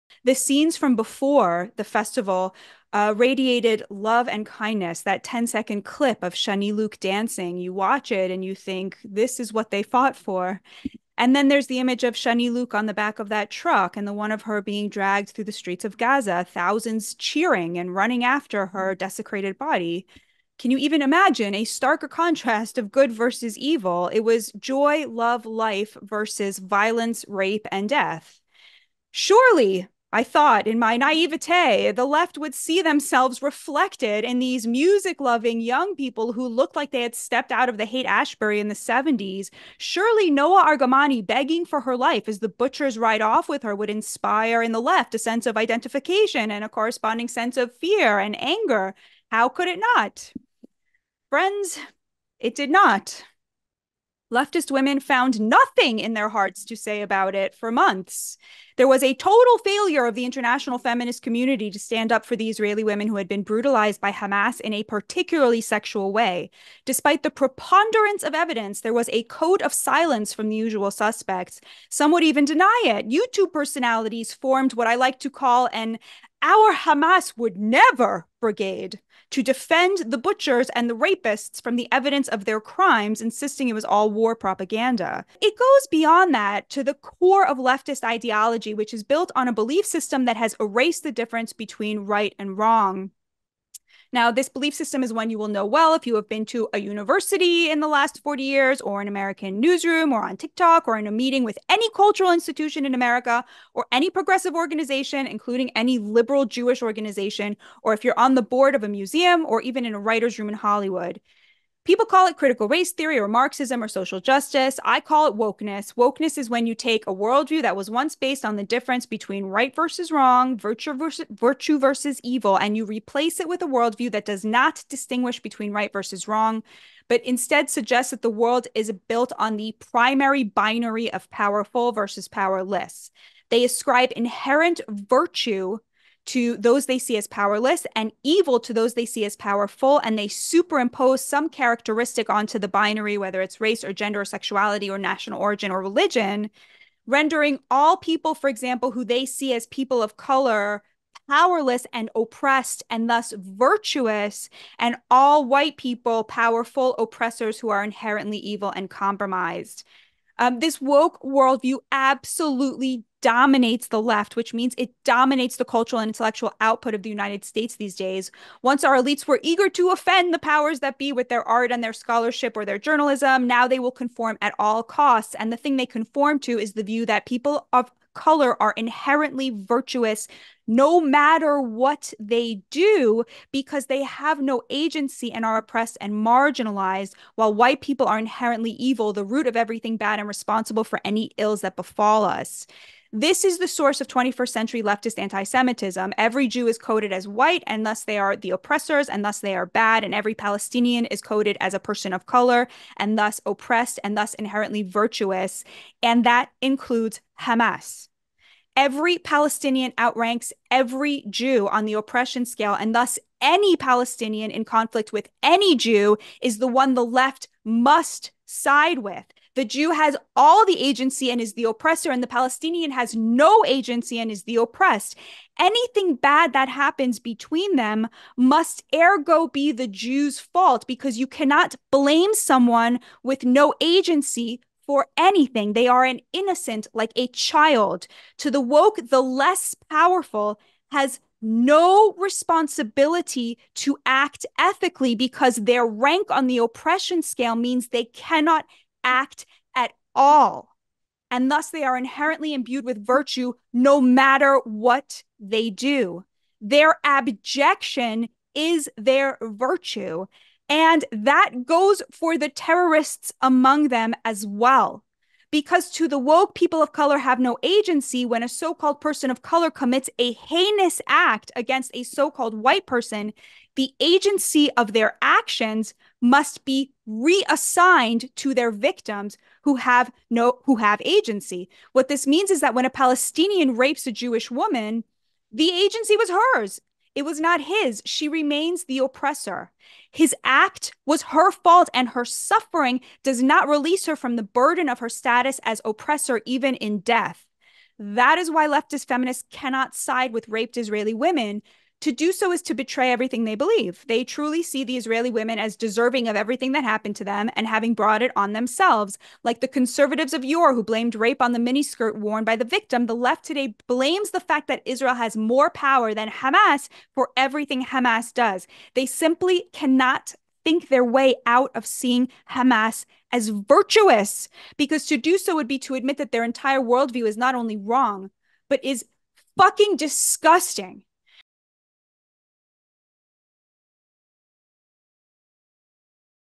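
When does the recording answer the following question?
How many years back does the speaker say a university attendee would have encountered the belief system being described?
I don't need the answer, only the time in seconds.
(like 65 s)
98 s.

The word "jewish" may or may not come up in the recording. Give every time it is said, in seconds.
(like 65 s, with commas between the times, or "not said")
106 s, 284 s.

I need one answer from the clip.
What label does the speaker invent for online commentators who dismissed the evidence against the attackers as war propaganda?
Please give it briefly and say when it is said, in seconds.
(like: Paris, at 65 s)
our Hamas would never brigade, at 76 s.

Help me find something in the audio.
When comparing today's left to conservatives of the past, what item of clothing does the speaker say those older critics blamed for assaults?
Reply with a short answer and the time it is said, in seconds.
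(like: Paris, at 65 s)
miniskirt, at 311 s.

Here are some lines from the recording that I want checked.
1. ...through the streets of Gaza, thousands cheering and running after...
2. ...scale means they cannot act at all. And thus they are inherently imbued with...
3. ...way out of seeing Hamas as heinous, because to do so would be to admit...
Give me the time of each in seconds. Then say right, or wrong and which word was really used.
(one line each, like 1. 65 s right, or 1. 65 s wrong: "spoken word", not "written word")
1. 15 s right
2. 247 s right
3. 321 s wrong: "virtuous", not "heinous".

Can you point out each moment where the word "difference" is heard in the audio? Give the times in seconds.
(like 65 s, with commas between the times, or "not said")
91 s, 118 s.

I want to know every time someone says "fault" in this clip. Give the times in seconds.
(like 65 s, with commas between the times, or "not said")
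230 s, 291 s.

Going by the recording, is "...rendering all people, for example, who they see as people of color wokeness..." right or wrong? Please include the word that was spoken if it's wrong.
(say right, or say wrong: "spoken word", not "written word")
wrong: "powerless", not "wokeness".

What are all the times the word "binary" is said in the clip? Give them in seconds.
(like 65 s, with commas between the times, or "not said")
130 s, 142 s.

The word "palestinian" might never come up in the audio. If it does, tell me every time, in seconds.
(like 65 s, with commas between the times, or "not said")
200 s, 209 s, 213 s, 222 s, 282 s.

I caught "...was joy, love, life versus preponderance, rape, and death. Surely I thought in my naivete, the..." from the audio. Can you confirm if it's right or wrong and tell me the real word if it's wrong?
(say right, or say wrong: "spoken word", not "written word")
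wrong: "violence", not "preponderance".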